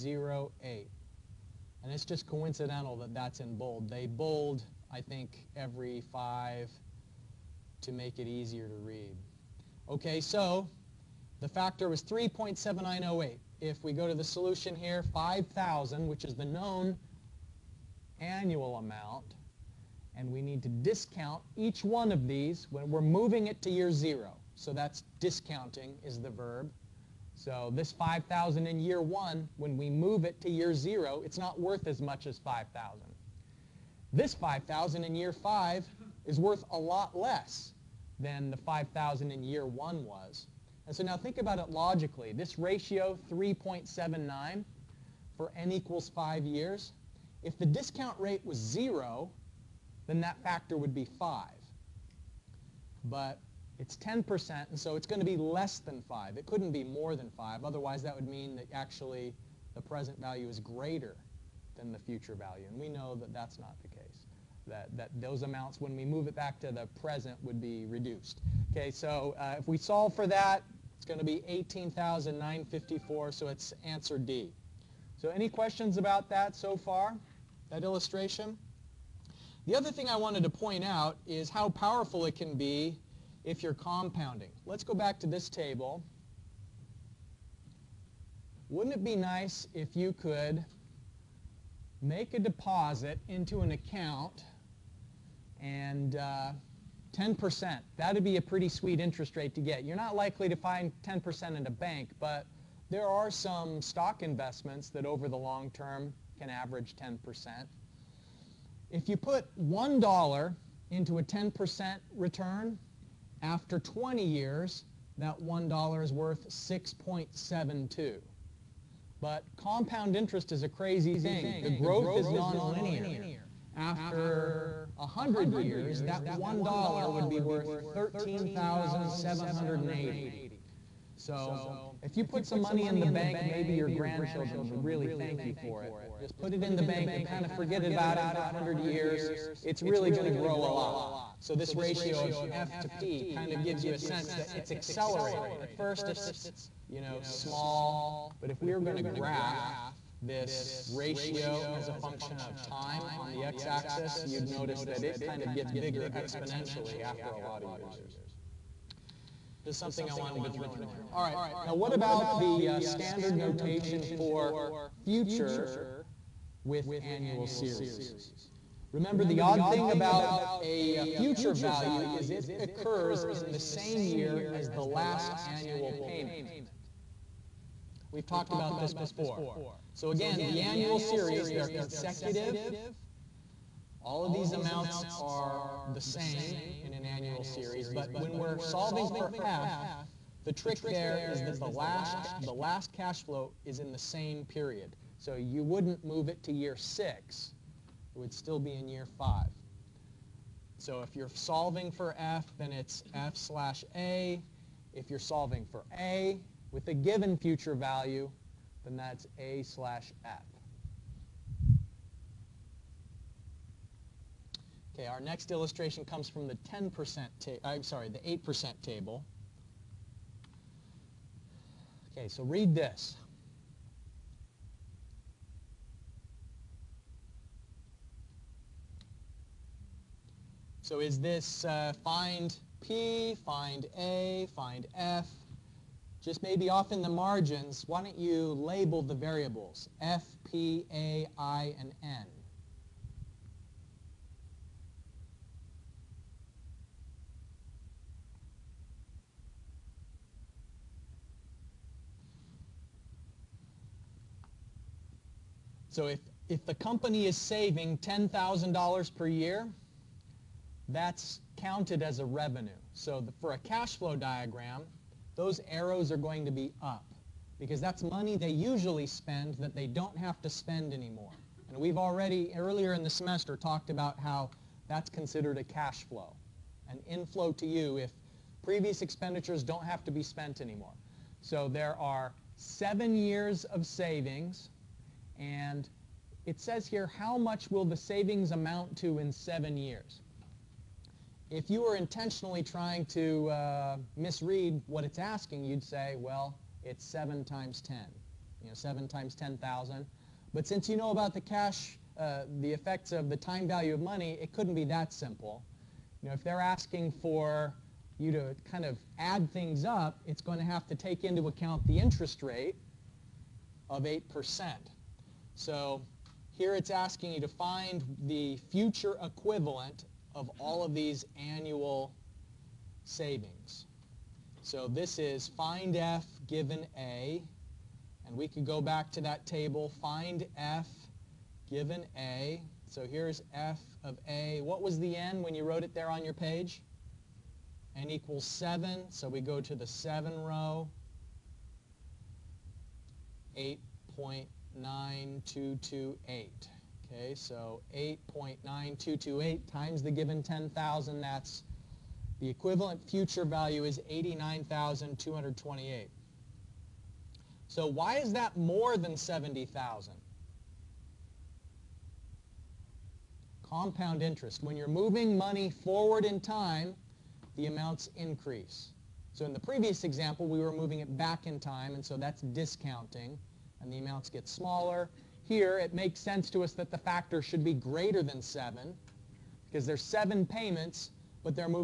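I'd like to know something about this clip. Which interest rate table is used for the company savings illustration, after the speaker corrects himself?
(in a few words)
8%.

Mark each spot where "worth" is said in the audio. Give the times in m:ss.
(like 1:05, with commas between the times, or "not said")
0:31, 0:36, 1:56, 2:07.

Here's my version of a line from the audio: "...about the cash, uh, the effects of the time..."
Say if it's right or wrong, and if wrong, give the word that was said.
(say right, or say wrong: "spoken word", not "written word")
right.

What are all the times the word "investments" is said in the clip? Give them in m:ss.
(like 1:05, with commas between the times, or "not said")
1:44.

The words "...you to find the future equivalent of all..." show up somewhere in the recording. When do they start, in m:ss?
5:17.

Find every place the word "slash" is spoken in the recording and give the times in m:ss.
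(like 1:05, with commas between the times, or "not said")
3:23, 3:29.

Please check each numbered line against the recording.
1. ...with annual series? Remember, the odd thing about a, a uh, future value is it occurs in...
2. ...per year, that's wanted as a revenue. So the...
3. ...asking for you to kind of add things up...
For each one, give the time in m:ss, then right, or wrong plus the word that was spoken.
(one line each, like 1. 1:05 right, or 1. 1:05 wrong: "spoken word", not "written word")
1. 2:46 right
2. 4:19 wrong: "counted", not "wanted"
3. 5:06 right.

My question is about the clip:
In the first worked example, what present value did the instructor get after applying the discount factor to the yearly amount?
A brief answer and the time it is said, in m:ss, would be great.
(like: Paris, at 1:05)
18,954, at 1:11.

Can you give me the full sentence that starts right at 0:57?
Otherwise, that would mean that actually the present value is greater than the future value.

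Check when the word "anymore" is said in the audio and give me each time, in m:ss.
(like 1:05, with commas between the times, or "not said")
4:30, 4:40.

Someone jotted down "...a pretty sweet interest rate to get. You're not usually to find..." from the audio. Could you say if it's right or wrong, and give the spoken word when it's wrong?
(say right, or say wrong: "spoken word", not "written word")
wrong: "likely", not "usually".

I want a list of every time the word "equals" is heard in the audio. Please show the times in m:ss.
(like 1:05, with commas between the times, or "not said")
0:45, 5:38.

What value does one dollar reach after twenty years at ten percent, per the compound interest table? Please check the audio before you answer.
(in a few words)
6.72.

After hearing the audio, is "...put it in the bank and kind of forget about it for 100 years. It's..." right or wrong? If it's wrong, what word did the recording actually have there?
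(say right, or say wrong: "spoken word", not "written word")
right.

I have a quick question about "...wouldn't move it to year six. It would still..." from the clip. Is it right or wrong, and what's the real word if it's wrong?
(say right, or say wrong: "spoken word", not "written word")
right.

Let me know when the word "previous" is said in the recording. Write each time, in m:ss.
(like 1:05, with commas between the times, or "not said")
4:38, 6:09.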